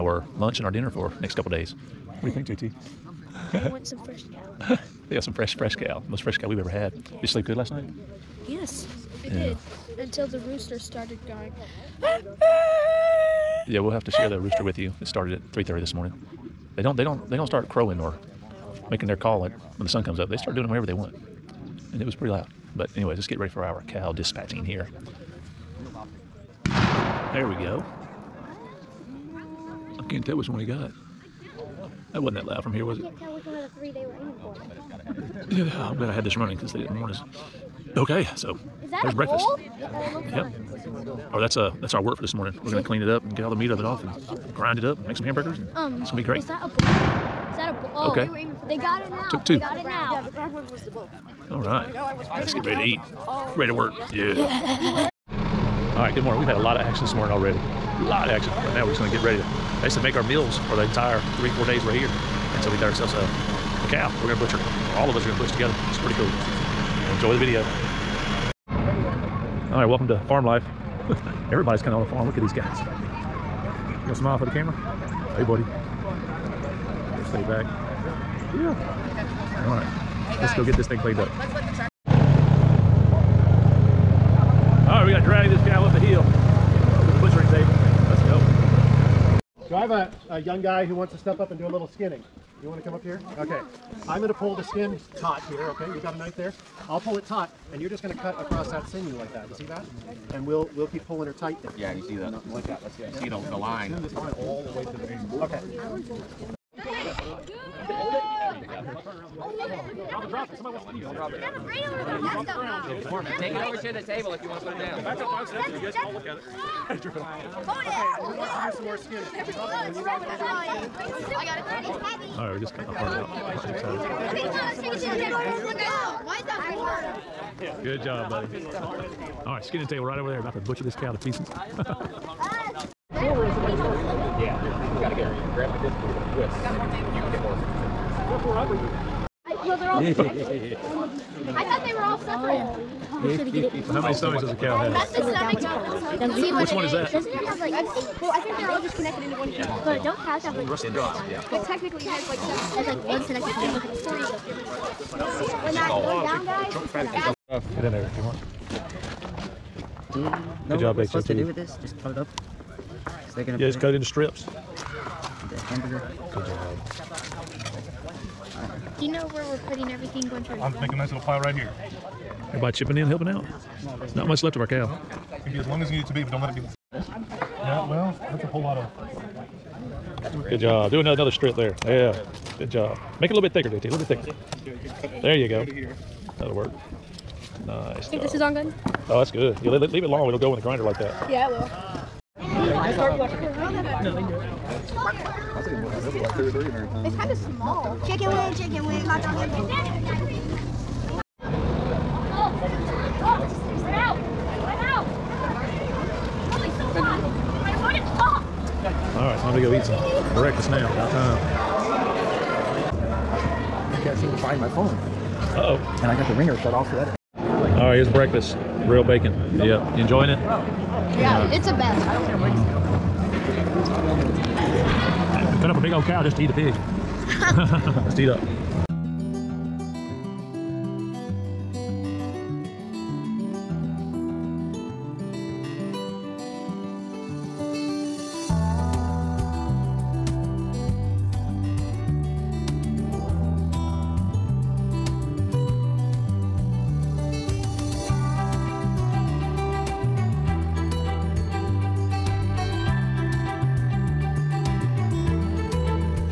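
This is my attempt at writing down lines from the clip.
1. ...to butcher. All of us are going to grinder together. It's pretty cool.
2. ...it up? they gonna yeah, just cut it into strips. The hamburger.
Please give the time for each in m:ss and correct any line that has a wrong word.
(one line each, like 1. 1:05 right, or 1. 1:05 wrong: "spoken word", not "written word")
1. 1:04 wrong: "butcher", not "grinder"
2. 2:42 right.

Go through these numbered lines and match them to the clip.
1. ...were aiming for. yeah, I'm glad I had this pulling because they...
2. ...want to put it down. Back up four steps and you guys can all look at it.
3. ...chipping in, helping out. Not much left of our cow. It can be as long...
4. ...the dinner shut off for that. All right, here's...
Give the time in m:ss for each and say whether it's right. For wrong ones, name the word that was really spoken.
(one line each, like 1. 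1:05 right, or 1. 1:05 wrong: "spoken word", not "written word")
1. 0:34 wrong: "running", not "pulling"
2. 1:54 wrong: "five", not "four"
3. 2:52 right
4. 3:36 wrong: "ringer", not "dinner".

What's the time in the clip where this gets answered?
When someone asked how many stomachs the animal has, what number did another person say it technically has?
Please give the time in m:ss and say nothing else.
2:32.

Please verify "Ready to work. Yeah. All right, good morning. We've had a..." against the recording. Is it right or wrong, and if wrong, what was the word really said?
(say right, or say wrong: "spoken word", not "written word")
right.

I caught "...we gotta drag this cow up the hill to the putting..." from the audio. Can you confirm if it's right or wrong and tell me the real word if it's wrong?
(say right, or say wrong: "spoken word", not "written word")
wrong: "butchering", not "putting".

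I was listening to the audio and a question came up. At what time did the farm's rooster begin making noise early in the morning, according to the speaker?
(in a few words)
3:30.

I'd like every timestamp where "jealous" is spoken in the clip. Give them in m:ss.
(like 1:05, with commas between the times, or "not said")
not said.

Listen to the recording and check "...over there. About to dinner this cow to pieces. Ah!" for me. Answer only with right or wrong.
wrong.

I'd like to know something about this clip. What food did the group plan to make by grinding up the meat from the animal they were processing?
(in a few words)
hamburgers.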